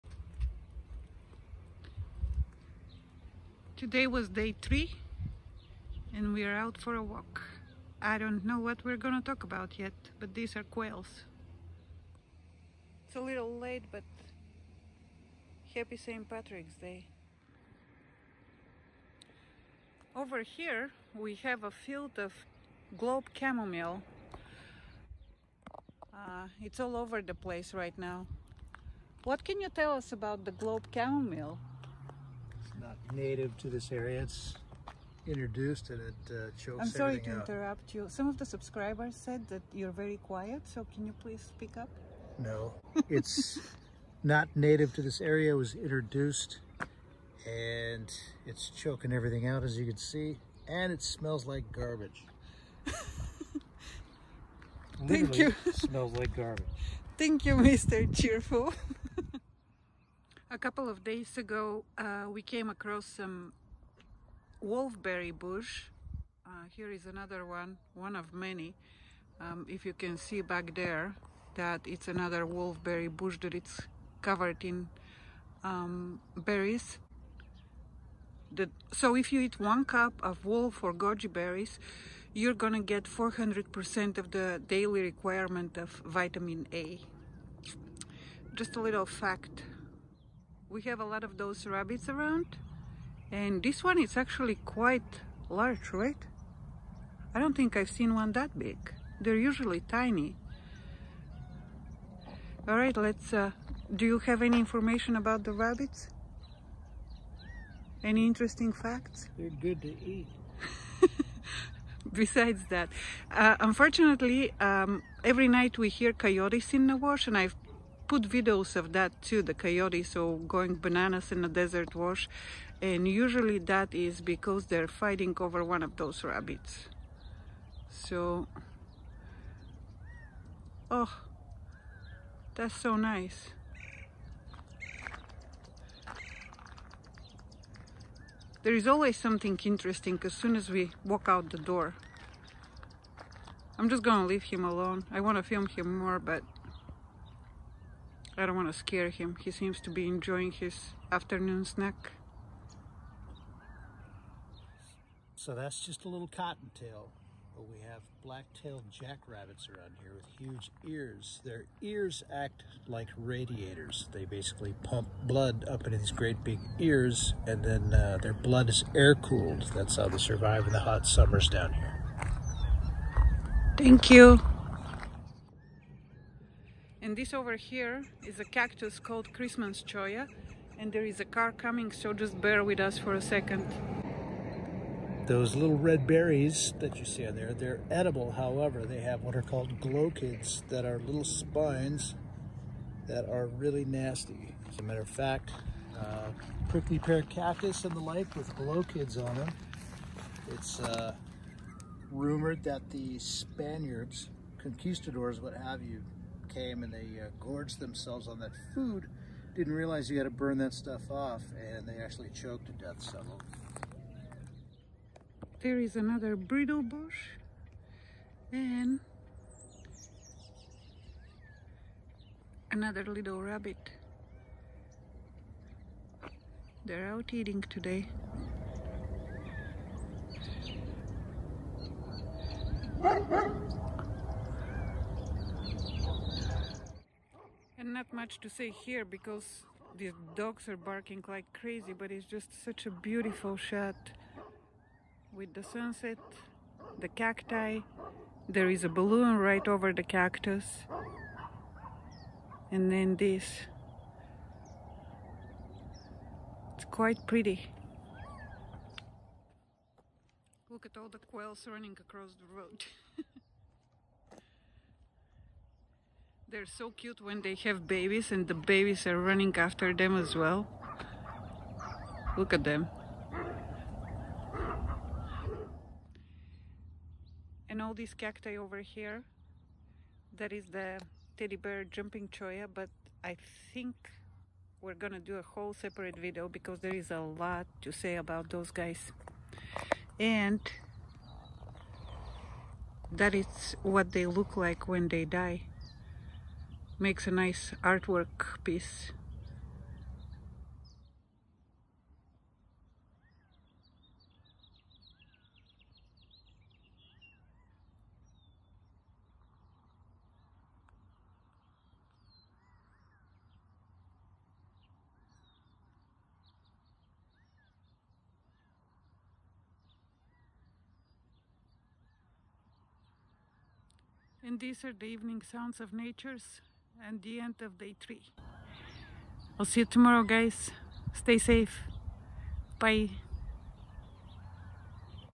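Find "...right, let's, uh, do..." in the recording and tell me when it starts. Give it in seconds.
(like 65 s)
102 s.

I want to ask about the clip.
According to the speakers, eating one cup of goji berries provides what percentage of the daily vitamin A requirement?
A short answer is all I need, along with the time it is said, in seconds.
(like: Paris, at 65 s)
400%, at 83 s.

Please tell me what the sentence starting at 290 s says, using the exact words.
And that is what they look like when they die makes a nice artwork piece.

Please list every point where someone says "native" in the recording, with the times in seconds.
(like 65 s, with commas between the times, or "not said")
33 s, 44 s.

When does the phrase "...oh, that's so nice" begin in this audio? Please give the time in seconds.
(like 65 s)
130 s.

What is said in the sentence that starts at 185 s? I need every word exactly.
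Those little red berries that you see on there, they're edible.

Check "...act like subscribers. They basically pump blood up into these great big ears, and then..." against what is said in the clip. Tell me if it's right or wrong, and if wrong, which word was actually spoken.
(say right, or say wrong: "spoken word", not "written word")
wrong: "radiators", not "subscribers".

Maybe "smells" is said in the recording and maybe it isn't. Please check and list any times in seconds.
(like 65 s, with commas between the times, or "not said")
51 s, 55 s.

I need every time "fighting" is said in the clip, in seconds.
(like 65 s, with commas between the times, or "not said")
125 s.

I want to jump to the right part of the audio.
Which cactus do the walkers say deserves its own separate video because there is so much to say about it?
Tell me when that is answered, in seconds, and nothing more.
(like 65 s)
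281 s.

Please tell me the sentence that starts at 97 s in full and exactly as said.
I don't think I've seen one that big.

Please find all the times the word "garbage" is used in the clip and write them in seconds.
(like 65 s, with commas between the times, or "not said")
51 s, 56 s.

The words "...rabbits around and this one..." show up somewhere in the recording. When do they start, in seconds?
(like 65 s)
91 s.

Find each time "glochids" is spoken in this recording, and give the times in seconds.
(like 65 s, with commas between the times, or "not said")
189 s, 198 s.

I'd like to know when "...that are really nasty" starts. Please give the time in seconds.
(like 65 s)
193 s.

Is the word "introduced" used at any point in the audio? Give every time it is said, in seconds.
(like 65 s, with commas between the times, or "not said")
35 s, 45 s.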